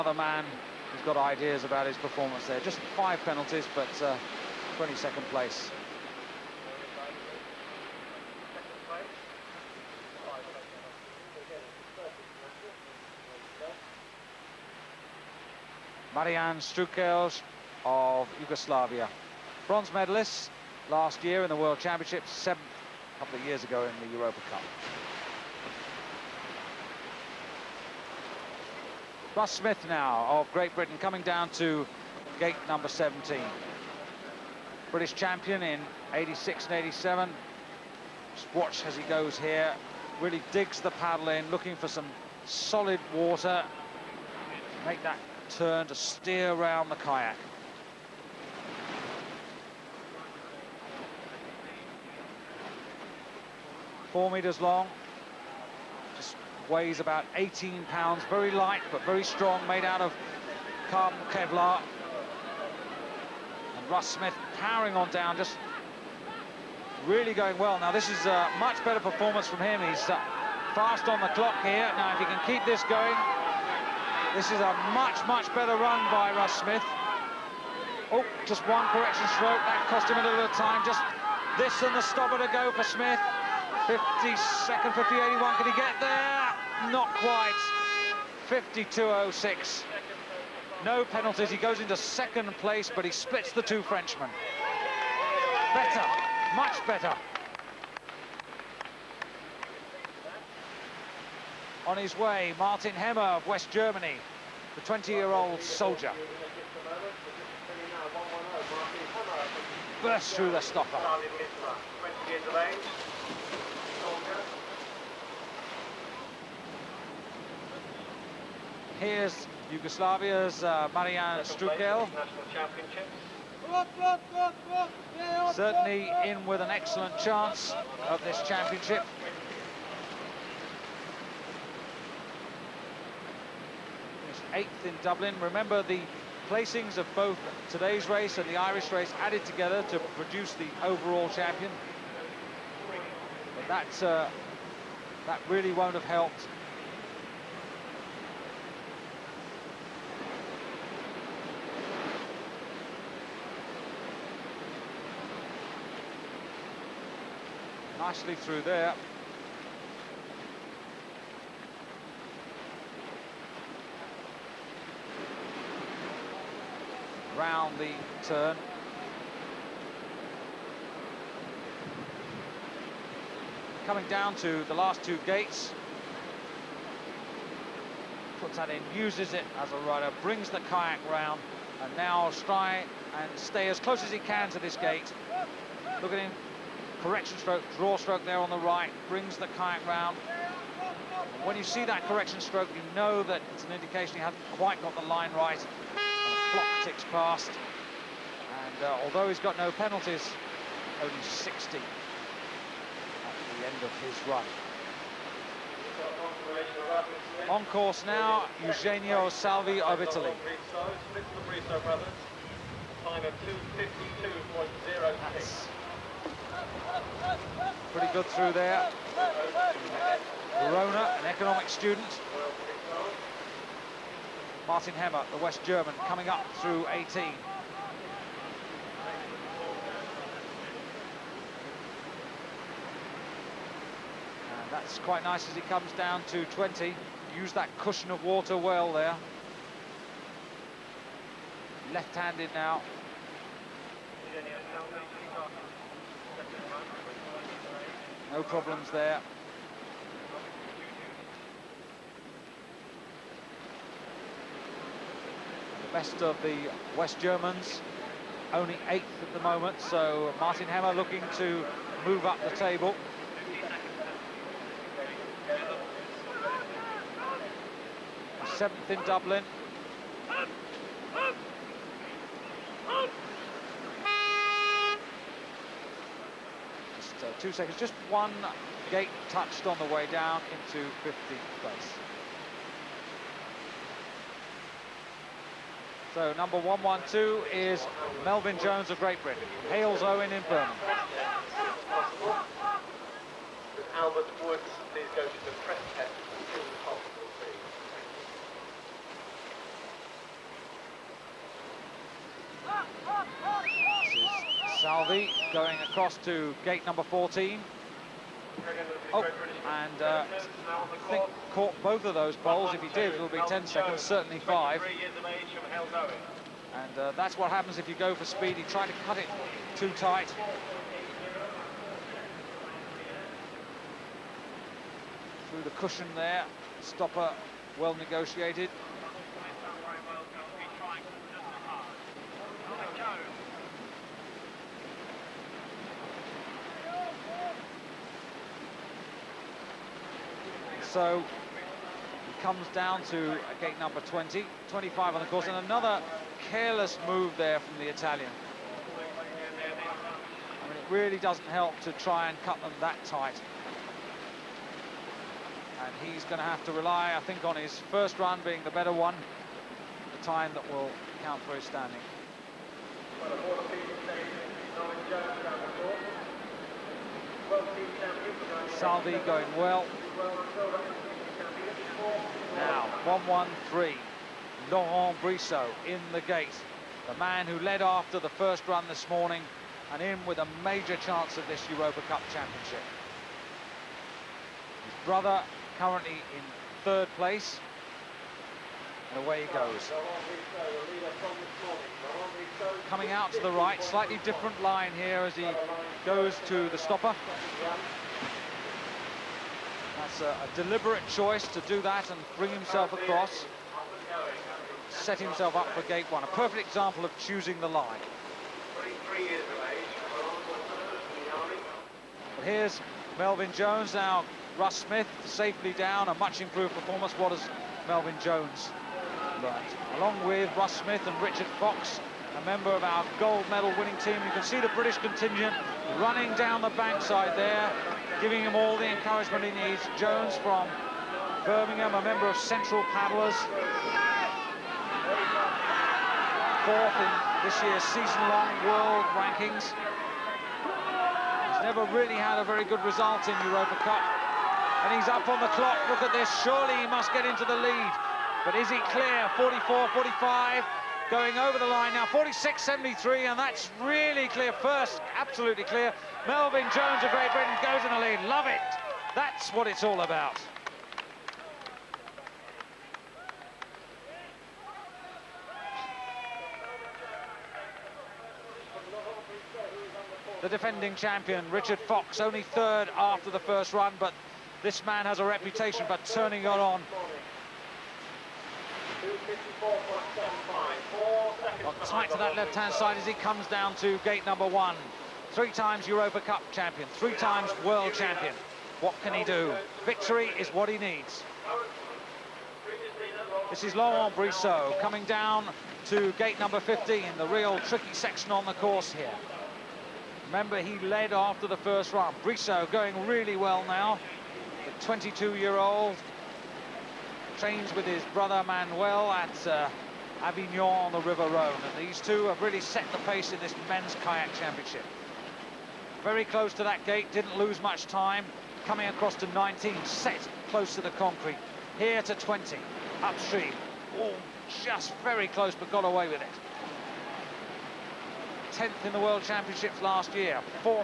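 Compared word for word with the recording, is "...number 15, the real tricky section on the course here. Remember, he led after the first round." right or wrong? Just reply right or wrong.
right.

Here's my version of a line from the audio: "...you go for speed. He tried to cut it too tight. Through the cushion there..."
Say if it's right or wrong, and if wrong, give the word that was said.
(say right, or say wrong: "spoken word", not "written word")
right.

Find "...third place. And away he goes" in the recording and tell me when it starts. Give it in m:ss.
6:26.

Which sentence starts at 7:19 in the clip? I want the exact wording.
He's never really had a very good result in Europa Cup.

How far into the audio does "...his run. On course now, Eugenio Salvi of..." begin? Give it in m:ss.
3:24.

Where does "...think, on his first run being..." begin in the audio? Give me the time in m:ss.
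5:57.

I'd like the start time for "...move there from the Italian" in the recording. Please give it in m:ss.
5:47.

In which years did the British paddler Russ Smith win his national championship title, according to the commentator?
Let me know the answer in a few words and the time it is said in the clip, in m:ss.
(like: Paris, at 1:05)
1986 and 1987, at 0:36.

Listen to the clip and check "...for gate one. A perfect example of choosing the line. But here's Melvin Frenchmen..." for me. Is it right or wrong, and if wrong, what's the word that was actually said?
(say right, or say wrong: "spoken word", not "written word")
wrong: "Jones", not "Frenchmen".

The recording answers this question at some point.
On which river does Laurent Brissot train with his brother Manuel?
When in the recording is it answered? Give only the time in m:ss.
8:31.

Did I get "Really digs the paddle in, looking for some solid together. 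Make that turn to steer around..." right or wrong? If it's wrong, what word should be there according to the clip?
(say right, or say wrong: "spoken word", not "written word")
wrong: "water", not "together".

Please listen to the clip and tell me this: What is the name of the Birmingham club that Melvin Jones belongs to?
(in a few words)
Central Paddlers.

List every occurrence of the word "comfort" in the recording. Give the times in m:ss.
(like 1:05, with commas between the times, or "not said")
not said.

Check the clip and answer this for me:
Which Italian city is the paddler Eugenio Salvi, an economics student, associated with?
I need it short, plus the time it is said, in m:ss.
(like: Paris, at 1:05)
Verona, at 3:40.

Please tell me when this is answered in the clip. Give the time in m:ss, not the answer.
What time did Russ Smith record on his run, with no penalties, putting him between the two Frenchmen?
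1:28.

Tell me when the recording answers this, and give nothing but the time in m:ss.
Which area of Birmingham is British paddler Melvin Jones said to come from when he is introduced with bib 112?
4:49.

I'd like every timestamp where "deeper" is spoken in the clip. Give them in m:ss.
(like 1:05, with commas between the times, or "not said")
not said.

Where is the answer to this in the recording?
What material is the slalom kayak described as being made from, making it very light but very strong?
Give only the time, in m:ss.
1:00.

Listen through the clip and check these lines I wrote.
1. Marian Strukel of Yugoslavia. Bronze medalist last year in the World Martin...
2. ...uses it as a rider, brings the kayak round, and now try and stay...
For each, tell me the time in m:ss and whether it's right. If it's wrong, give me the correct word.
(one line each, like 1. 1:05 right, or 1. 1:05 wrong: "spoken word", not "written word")
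1. 0:16 wrong: "Championships", not "Martin"
2. 2:58 right.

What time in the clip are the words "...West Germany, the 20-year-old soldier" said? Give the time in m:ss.
1:43.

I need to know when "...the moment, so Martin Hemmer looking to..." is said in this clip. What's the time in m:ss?
4:19.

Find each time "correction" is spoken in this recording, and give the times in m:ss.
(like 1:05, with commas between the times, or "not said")
1:18, 3:07, 3:12.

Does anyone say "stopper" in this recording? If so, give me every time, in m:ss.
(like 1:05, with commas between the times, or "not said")
1:22, 1:50, 5:26, 6:36.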